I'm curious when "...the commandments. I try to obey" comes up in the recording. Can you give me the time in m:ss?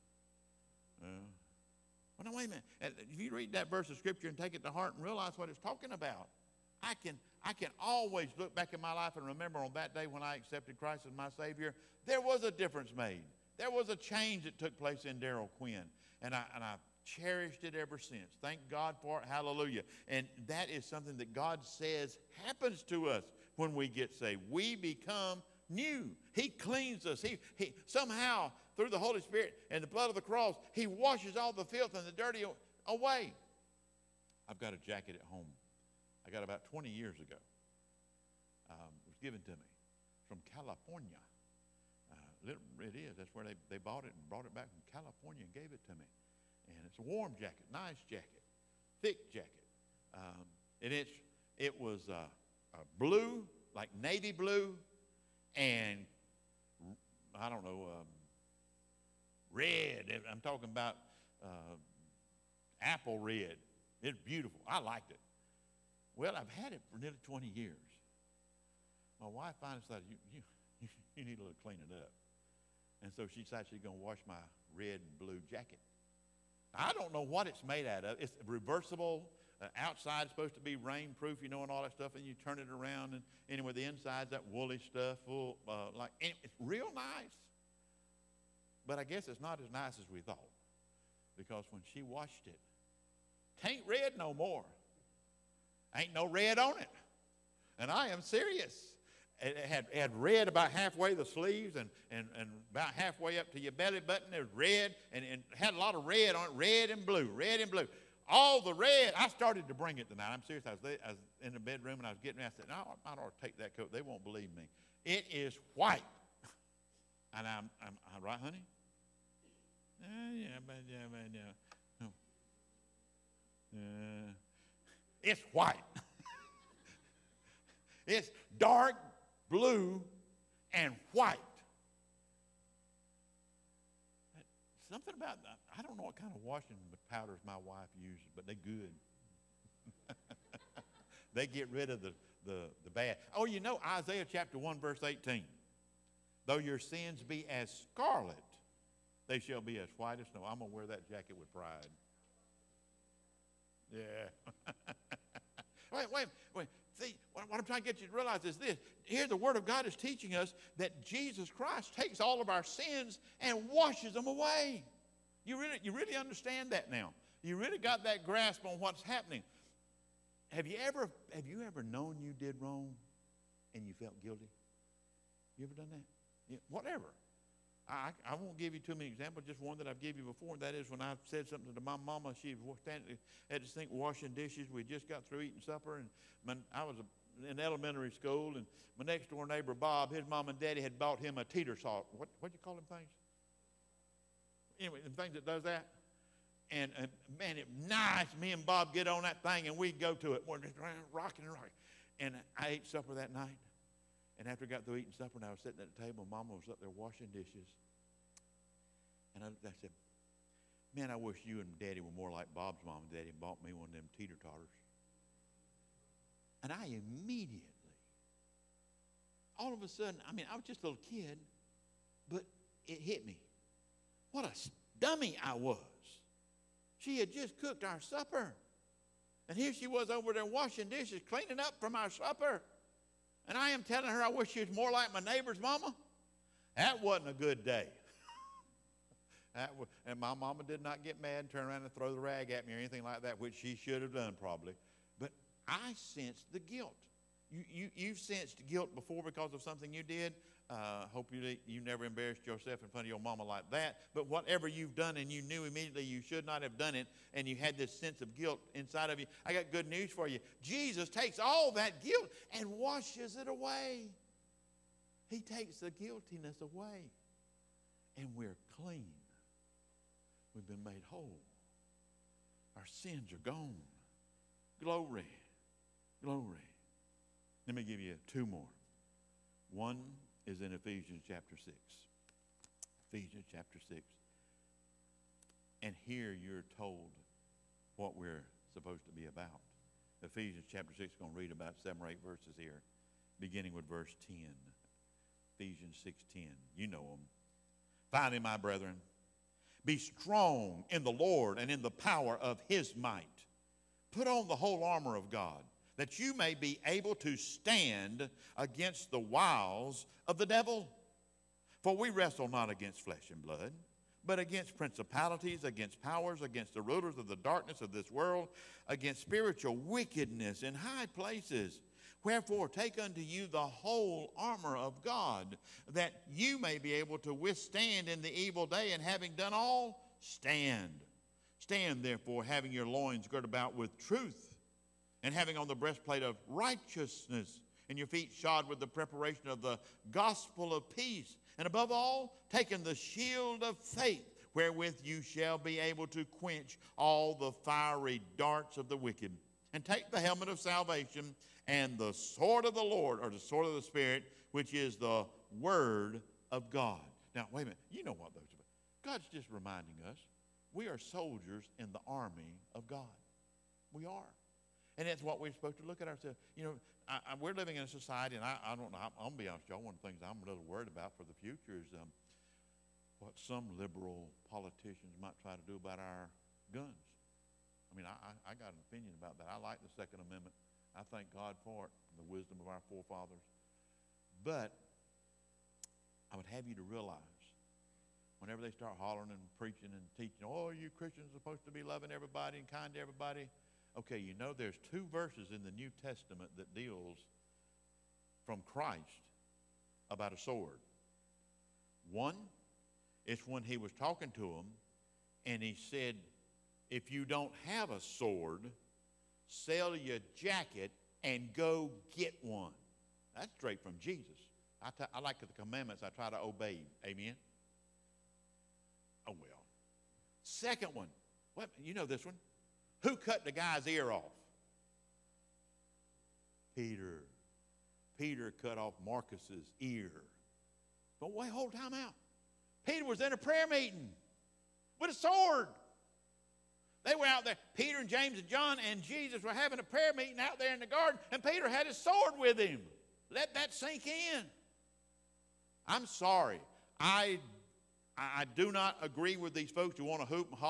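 6:55.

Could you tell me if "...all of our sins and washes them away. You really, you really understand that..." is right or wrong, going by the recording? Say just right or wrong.
right.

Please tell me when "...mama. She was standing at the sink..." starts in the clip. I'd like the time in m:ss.
3:02.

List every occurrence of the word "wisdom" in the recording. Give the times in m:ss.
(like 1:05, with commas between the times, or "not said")
6:22.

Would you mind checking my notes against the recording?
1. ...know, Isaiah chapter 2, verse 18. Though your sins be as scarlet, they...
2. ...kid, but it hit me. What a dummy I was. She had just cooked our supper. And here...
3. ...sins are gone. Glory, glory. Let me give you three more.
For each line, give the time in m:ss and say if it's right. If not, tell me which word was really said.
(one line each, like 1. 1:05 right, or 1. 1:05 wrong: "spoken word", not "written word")
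1. 2:23 wrong: "1", not "2"
2. 3:41 right
3. 4:32 wrong: "two", not "three".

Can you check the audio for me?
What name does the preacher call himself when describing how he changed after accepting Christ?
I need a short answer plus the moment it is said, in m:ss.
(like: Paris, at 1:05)
Daryl Quinn, at 0:15.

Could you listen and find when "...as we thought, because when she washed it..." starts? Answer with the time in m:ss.
1:29.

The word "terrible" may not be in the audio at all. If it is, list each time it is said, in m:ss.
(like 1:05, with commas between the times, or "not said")
not said.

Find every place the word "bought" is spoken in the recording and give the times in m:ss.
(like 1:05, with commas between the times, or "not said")
0:43, 3:10, 3:33.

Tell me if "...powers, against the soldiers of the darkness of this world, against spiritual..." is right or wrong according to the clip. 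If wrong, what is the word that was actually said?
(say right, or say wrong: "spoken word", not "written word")
wrong: "rulers", not "soldiers".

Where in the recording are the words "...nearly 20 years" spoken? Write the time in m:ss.
1:06.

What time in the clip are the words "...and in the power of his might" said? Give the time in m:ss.
5:01.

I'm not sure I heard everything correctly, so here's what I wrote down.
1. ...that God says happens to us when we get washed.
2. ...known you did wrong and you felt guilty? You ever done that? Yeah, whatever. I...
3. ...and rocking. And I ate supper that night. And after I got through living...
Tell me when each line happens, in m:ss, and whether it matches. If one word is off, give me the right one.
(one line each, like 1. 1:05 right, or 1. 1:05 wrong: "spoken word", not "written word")
1. 0:21 wrong: "saved", not "washed"
2. 2:51 right
3. 3:21 wrong: "eating", not "living".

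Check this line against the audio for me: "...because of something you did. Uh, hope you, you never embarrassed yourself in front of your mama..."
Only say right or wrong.
right.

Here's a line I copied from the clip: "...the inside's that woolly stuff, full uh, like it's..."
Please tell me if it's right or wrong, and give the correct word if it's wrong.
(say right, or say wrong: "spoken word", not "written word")
right.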